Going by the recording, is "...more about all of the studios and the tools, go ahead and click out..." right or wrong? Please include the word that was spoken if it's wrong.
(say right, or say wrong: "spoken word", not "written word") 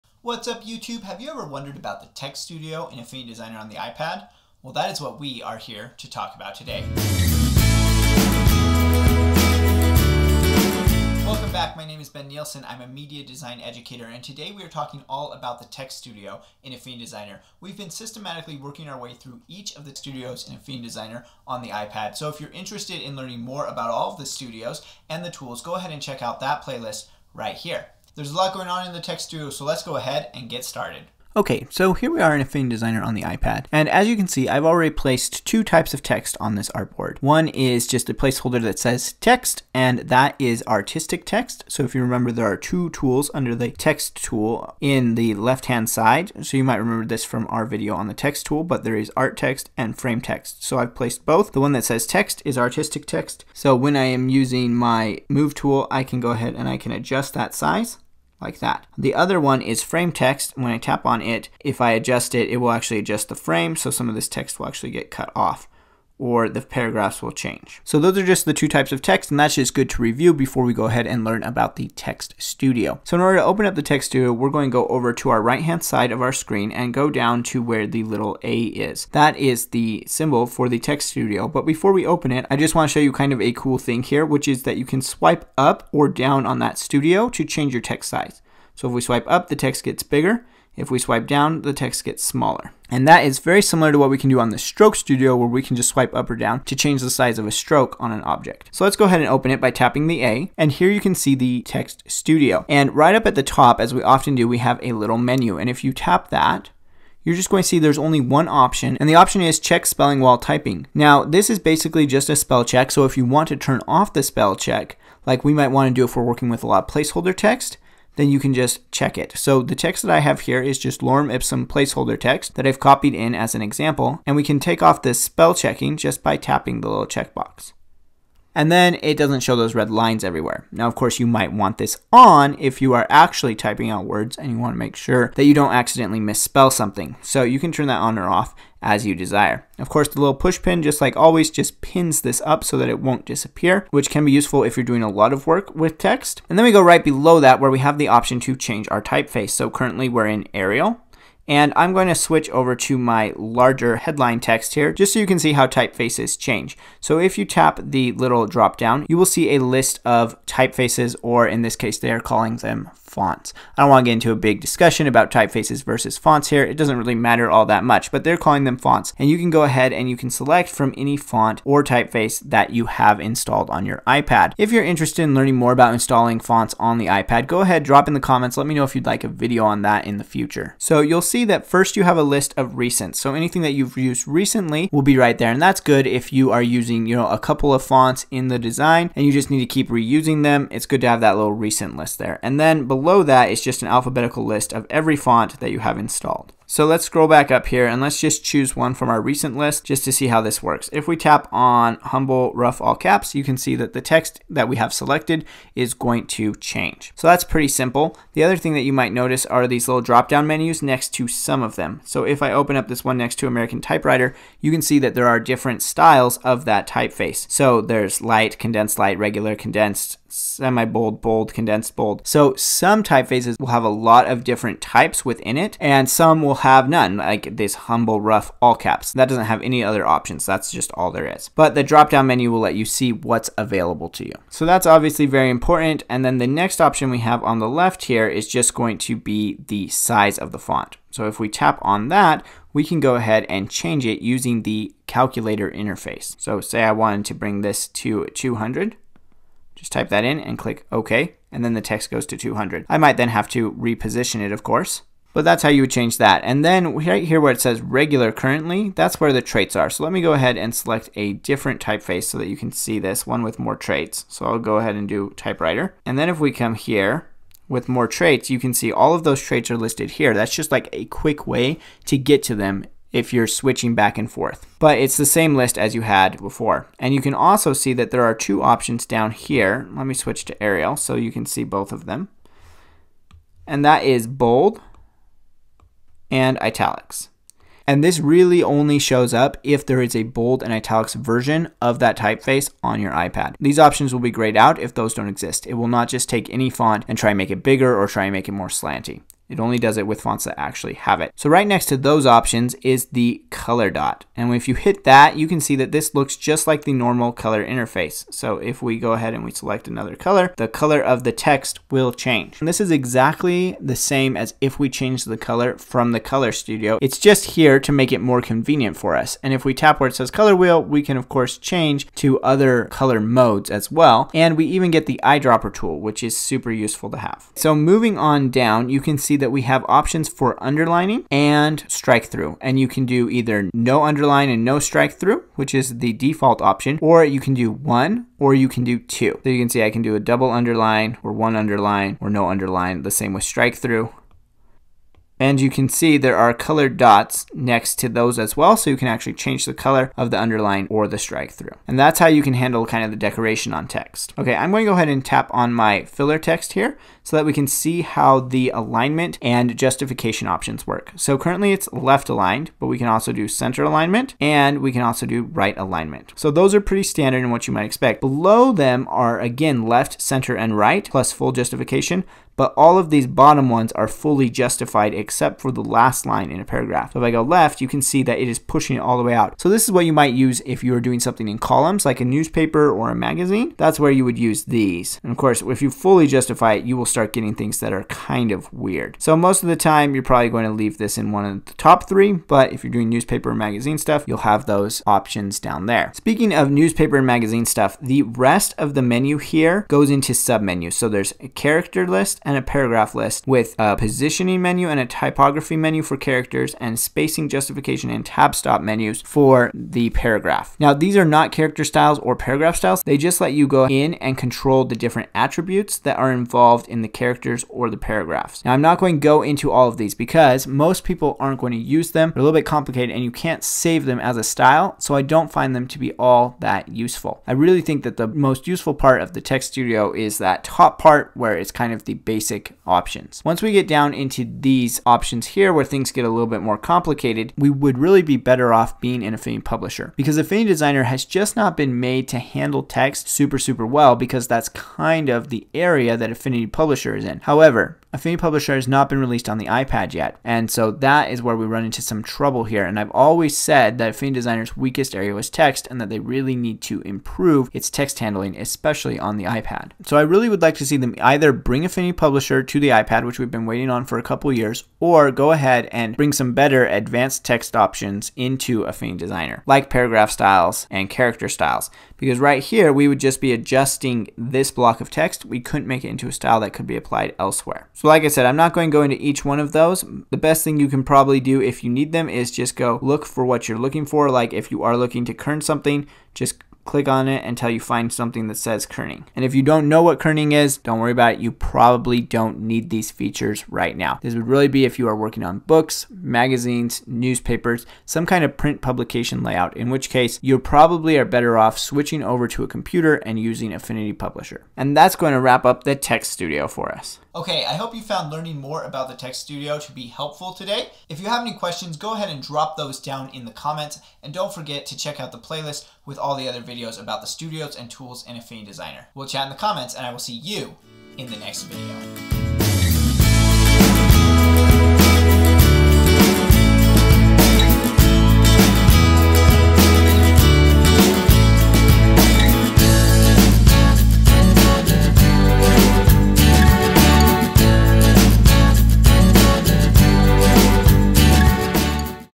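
wrong: "check", not "click".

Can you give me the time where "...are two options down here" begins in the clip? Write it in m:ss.
4:38.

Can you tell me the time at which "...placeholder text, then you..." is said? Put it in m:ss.
1:56.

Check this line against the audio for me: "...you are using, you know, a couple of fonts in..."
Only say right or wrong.
right.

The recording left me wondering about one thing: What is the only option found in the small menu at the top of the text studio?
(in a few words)
Check spelling while typing.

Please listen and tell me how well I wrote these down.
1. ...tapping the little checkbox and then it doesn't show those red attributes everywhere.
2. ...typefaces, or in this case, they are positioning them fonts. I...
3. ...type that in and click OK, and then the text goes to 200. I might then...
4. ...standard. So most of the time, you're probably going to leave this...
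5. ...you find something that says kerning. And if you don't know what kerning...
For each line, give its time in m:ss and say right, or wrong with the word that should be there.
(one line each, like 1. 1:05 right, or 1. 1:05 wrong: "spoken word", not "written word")
1. 2:06 wrong: "lines", not "attributes"
2. 2:40 wrong: "calling", not "positioning"
3. 4:09 right
4. 6:28 wrong: "weird", not "standard"
5. 8:07 right.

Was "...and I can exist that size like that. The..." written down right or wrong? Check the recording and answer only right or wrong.
wrong.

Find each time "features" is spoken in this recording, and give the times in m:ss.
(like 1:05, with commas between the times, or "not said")
8:13.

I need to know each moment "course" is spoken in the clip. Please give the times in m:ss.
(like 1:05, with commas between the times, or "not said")
2:10, 2:19, 4:14, 5:21, 6:25.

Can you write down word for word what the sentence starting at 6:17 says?
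If I go left, you can see that it is pushing it all the way out.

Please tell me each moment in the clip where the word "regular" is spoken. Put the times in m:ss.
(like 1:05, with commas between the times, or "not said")
3:39, 4:17.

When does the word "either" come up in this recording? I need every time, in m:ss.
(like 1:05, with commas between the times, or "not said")
5:33, 7:41.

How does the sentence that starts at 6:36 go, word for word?
Speaking of newspaper and magazine stuff, the rest of the menu here goes into submenus.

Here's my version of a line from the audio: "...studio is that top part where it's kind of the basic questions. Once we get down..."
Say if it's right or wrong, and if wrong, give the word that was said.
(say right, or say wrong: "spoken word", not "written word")
wrong: "options", not "questions".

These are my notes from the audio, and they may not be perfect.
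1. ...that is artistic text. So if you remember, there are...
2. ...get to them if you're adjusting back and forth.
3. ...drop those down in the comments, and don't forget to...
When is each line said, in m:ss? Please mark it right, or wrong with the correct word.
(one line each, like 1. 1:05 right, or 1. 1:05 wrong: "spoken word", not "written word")
1. 0:39 right
2. 4:32 wrong: "switching", not "adjusting"
3. 8:32 right.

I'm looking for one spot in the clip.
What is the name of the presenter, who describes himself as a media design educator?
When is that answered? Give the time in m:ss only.
0:12.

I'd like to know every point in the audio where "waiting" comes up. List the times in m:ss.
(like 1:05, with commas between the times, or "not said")
7:43.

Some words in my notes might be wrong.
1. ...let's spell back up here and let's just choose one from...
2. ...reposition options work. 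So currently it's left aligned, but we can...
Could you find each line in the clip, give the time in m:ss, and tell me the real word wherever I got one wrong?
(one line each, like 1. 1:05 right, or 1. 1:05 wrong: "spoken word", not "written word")
1. 3:16 wrong: "scroll", not "spell"
2. 5:59 wrong: "justification", not "reposition".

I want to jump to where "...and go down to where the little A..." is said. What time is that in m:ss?
1:16.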